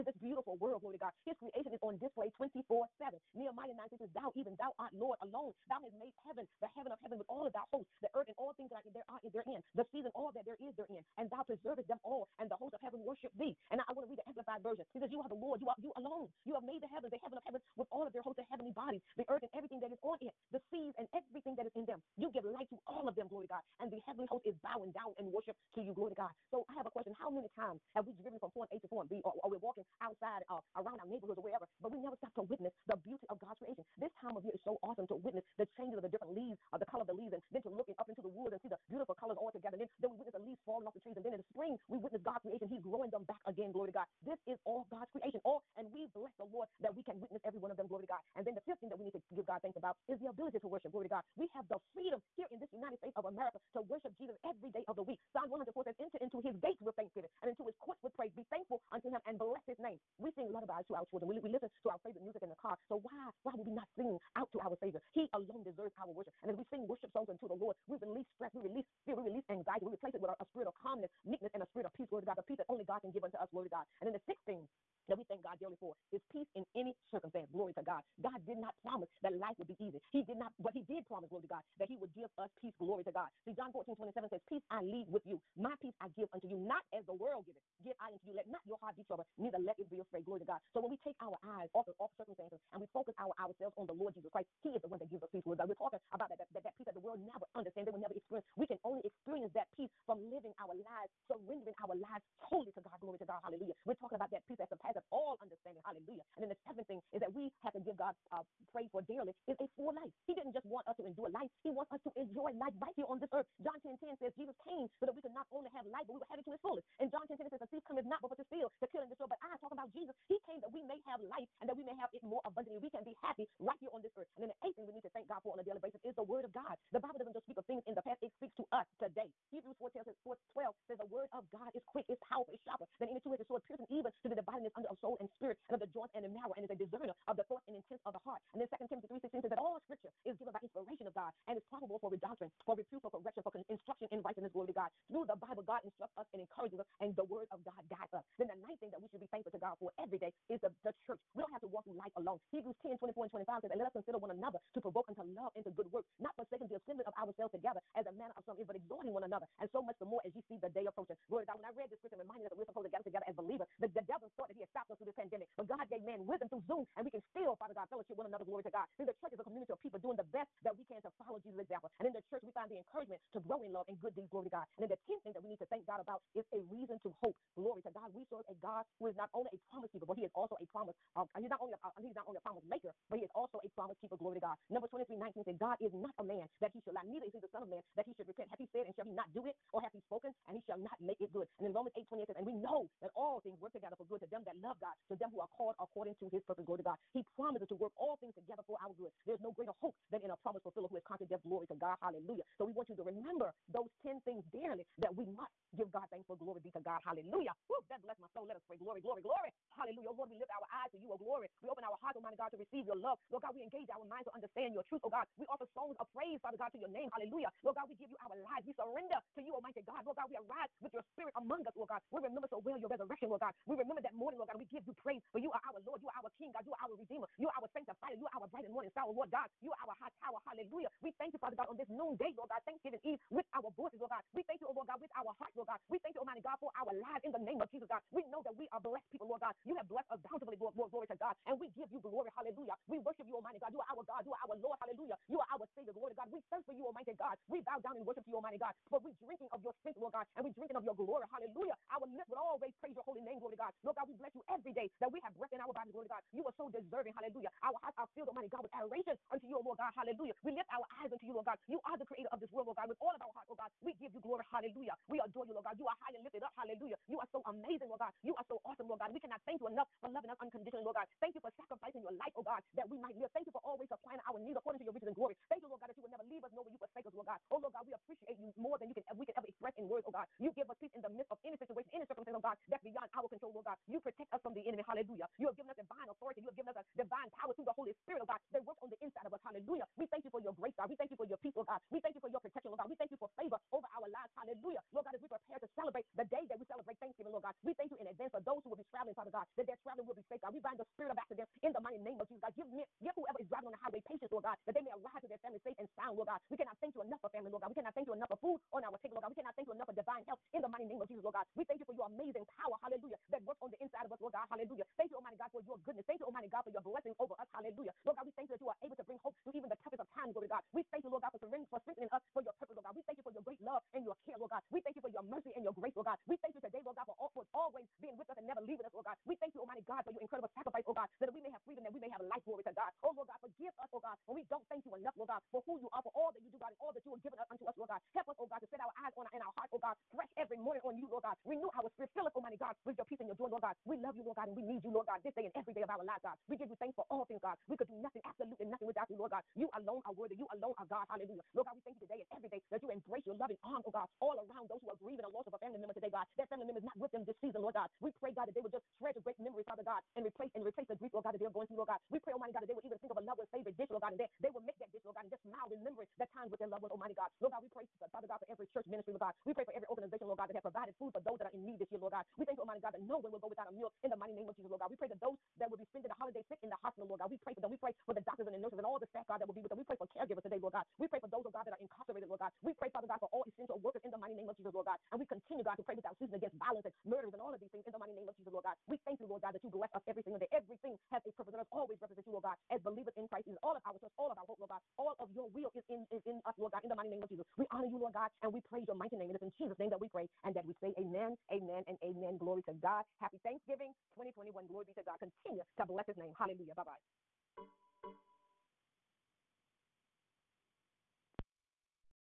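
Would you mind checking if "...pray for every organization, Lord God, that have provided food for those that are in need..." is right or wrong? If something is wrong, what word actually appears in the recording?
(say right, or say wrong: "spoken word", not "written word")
right.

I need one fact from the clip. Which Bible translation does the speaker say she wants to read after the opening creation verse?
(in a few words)
Amplified Version.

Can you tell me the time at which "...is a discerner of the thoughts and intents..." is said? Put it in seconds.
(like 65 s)
136 s.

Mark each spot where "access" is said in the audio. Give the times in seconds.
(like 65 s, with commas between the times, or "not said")
not said.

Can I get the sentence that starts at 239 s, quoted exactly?
You have blessed us bountifully, Lord, Lord glory to God.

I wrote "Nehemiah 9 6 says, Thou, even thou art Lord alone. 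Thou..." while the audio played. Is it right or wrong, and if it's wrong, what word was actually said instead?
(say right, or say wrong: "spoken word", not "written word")
right.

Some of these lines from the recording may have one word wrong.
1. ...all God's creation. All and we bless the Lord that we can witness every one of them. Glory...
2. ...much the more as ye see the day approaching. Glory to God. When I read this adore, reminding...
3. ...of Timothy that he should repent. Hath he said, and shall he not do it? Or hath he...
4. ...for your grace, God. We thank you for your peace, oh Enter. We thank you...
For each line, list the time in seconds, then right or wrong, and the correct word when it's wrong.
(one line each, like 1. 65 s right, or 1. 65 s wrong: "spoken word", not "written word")
1. 44 s right
2. 159 s wrong: "scripture", not "adore"
3. 187 s wrong: "Man", not "Timothy"
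4. 290 s wrong: "God", not "Enter".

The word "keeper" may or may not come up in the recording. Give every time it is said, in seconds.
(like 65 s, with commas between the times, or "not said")
179 s, 184 s.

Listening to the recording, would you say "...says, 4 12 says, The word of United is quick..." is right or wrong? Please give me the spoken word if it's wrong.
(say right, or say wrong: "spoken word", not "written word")
wrong: "God", not "United".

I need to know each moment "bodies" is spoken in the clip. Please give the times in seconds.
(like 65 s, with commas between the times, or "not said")
18 s, 255 s.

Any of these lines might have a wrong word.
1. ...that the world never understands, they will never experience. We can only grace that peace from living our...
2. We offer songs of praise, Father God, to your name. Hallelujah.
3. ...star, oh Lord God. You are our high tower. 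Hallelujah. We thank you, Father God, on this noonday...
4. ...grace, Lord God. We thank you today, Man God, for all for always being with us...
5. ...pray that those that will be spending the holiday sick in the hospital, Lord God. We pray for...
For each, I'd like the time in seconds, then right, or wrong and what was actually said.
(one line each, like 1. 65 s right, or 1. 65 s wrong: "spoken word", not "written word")
1. 96 s wrong: "experience", not "grace"
2. 215 s right
3. 228 s right
4. 325 s wrong: "Lord", not "Man"
5. 374 s right.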